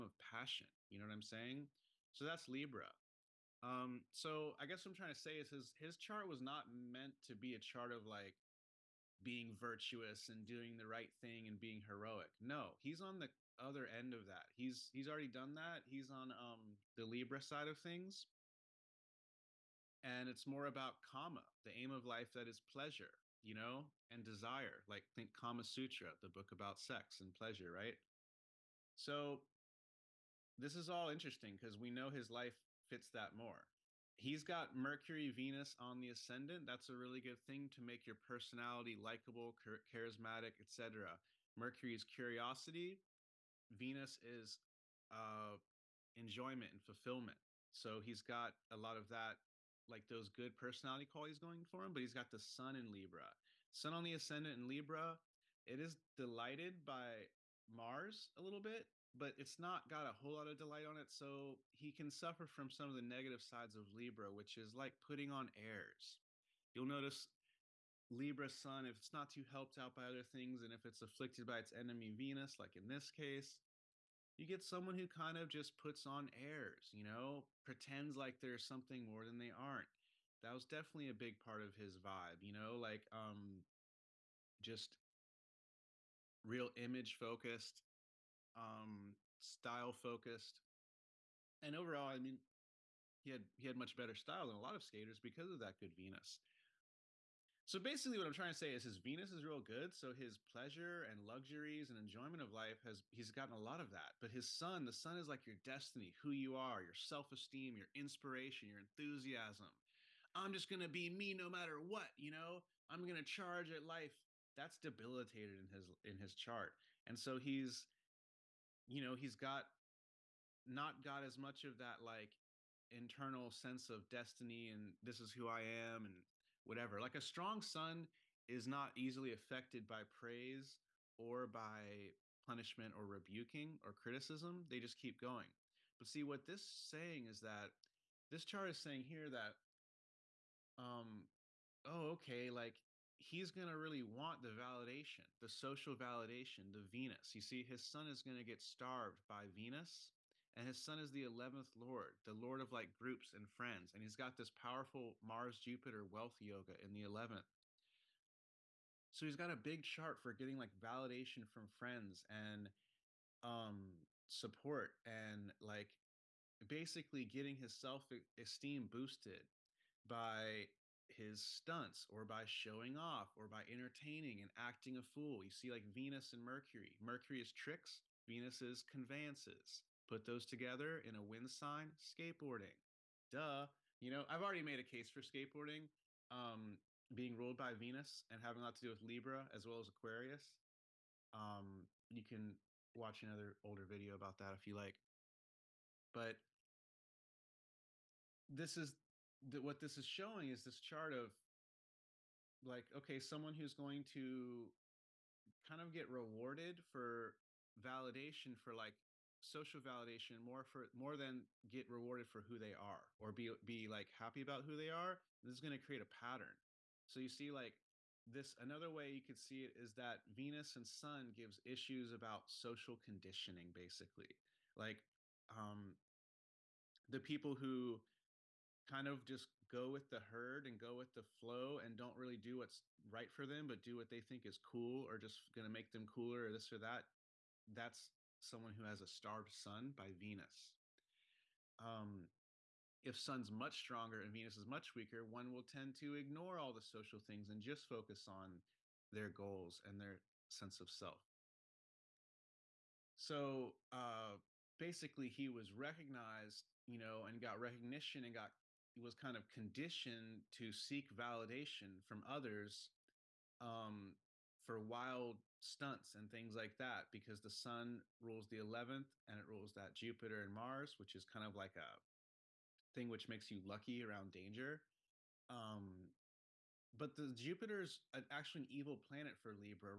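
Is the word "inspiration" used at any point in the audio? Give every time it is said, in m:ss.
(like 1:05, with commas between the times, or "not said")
1:47.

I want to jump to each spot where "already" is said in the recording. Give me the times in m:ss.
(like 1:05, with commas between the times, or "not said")
0:15, 3:04.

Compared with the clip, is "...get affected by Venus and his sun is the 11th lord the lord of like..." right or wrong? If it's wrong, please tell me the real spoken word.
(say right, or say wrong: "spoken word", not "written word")
wrong: "starved", not "affected".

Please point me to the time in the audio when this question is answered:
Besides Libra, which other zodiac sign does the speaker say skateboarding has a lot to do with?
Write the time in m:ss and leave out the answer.
3:09.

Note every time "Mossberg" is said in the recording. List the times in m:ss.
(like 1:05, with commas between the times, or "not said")
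not said.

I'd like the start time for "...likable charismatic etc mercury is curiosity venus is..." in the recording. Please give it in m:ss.
0:38.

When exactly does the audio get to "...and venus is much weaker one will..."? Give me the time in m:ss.
4:04.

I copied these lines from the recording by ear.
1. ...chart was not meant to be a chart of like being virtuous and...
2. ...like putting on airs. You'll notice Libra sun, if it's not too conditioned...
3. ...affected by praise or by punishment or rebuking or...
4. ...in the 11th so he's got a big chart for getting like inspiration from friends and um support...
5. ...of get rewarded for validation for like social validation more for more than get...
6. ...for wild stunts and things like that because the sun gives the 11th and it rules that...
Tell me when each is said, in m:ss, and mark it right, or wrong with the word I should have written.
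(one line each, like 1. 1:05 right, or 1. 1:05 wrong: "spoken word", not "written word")
1. 0:05 right
2. 1:04 wrong: "helped", not "conditioned"
3. 2:09 right
4. 2:36 wrong: "validation", not "inspiration"
5. 3:25 right
6. 4:24 wrong: "rules", not "gives".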